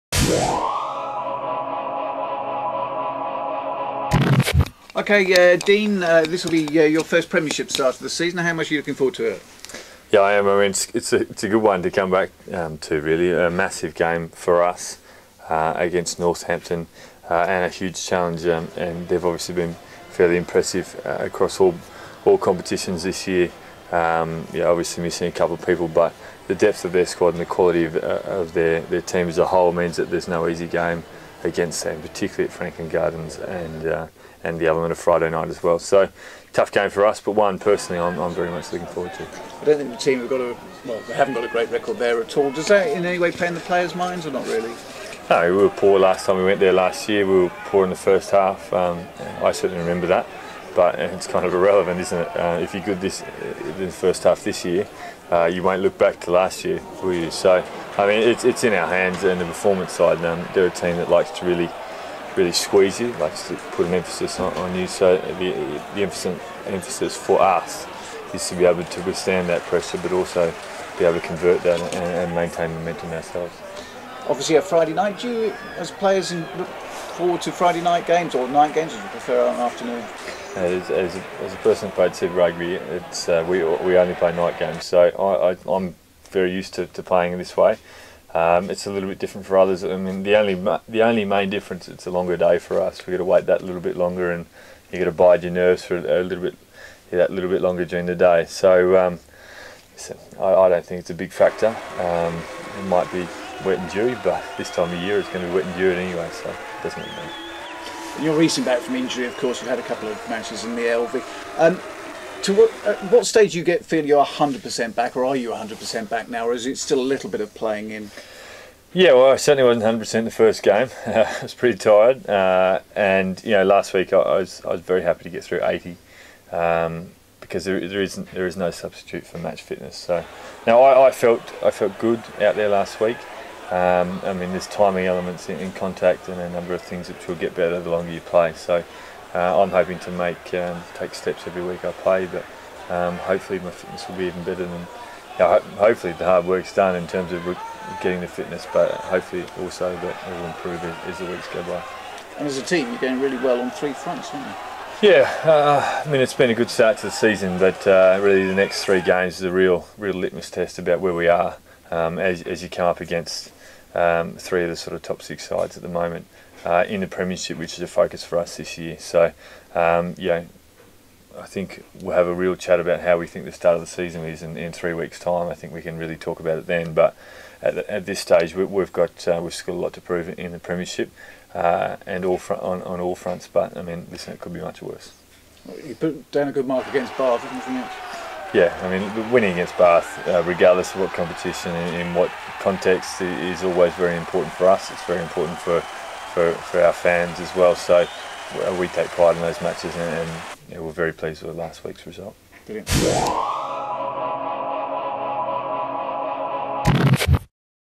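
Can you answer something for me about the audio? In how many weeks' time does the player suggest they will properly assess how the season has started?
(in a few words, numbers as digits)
3.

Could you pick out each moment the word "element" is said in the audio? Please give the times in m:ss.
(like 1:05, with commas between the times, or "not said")
0:34, 2:15.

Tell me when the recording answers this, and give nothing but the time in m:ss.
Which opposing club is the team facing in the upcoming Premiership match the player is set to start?
0:16.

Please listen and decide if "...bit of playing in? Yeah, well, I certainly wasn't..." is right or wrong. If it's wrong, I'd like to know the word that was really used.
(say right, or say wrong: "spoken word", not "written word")
right.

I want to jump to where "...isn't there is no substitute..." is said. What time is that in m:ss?
2:08.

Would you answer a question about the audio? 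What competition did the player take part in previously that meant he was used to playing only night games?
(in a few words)
Super Rugby.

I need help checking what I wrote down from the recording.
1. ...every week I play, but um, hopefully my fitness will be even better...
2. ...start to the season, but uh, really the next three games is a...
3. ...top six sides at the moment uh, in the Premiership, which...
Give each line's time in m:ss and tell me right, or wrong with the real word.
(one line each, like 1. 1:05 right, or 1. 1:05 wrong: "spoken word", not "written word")
1. 2:21 right
2. 2:36 right
3. 2:45 right.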